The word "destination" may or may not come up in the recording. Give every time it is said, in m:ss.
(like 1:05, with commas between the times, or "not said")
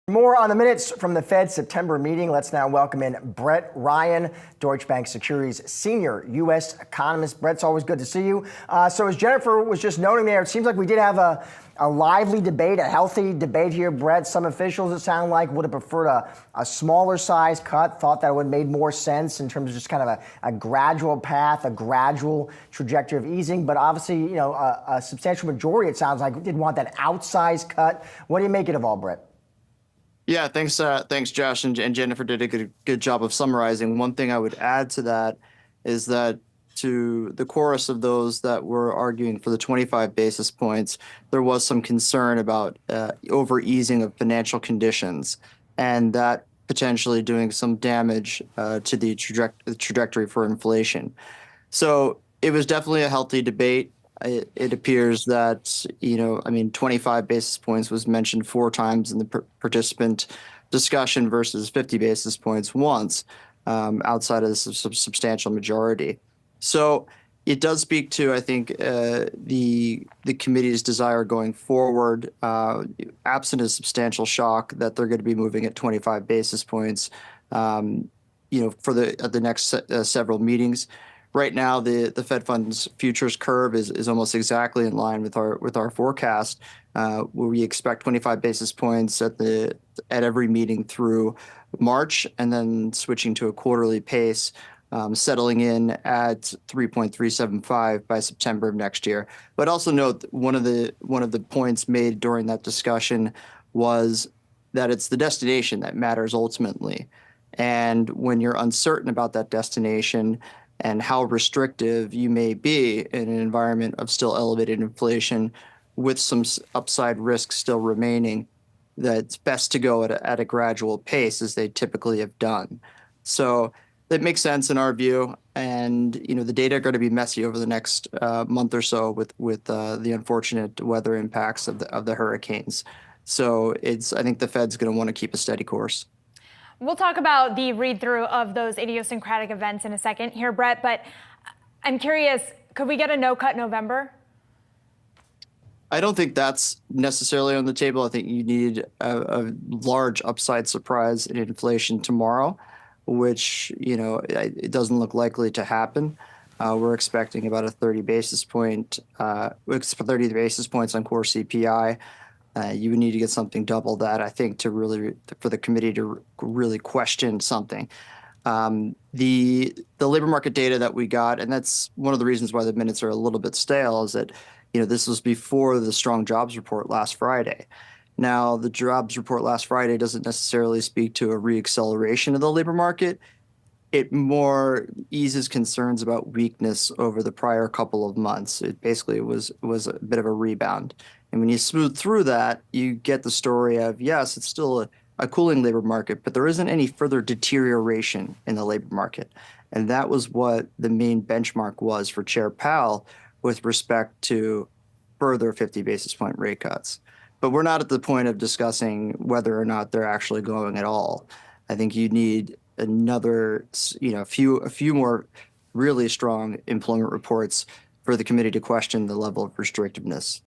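1:45, 1:49.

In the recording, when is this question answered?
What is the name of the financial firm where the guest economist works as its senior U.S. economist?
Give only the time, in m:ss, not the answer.
0:04.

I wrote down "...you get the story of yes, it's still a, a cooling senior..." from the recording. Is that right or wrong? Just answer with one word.
wrong.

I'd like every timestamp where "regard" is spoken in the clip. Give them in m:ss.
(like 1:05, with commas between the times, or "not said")
not said.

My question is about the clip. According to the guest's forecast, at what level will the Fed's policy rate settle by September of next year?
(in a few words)
3.375.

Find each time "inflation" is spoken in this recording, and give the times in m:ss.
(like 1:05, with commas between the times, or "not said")
0:50, 1:54, 2:31.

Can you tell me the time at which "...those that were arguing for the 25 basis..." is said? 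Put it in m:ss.
0:38.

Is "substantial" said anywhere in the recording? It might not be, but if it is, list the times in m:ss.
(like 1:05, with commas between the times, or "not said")
0:25, 1:04, 1:13.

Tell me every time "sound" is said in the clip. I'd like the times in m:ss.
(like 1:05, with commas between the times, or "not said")
0:14, 0:25.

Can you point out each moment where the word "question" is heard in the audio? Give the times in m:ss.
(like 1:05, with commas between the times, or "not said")
2:46, 3:38.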